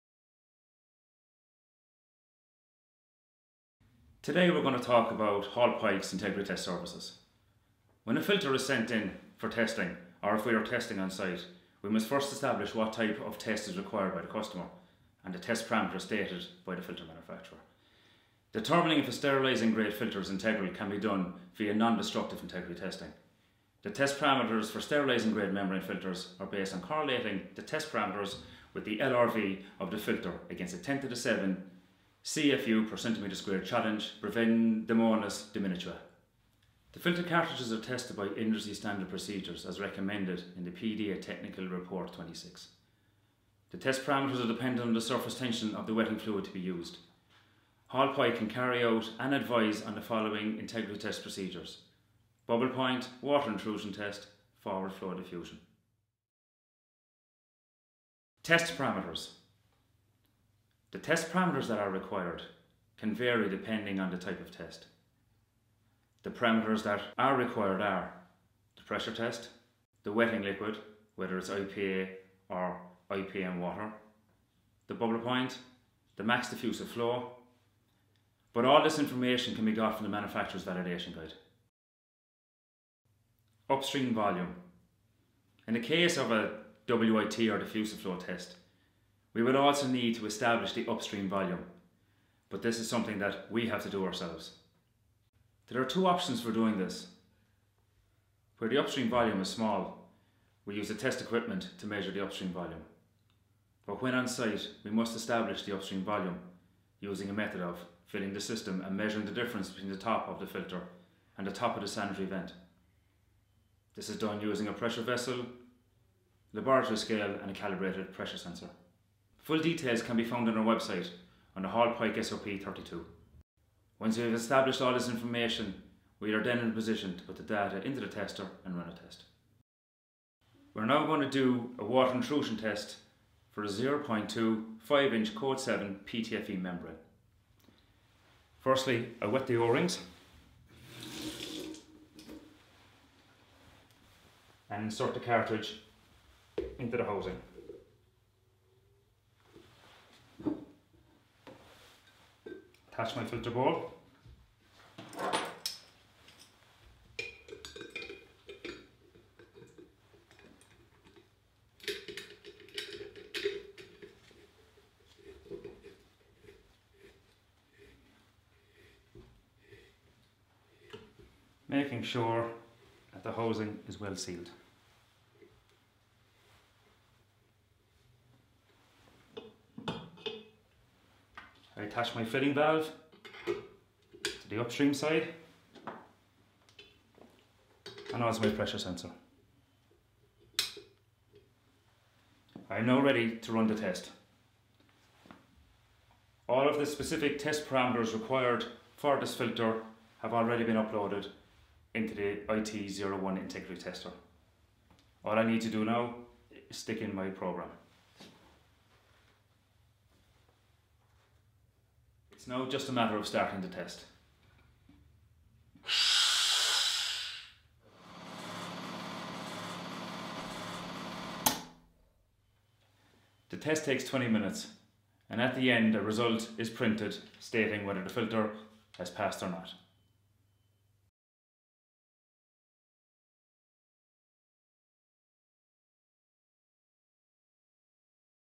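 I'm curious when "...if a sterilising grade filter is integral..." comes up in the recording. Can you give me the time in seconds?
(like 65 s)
18 s.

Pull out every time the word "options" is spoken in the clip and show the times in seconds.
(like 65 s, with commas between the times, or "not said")
96 s.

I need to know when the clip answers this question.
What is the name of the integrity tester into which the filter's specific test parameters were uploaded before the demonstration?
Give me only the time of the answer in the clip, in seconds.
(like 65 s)
202 s.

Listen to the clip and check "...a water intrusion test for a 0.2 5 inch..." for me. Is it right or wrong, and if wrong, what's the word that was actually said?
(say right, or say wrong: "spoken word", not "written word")
right.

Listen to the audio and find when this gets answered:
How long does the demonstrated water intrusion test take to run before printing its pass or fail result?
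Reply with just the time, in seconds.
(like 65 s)
224 s.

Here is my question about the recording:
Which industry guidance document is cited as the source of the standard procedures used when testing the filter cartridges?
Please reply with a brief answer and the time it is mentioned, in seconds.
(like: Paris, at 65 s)
PDA Technical Report 26, at 40 s.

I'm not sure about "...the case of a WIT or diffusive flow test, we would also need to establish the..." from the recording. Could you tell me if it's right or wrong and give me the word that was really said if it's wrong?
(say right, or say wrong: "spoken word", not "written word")
right.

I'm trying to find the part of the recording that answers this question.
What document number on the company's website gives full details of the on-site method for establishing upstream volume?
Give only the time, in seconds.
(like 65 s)
122 s.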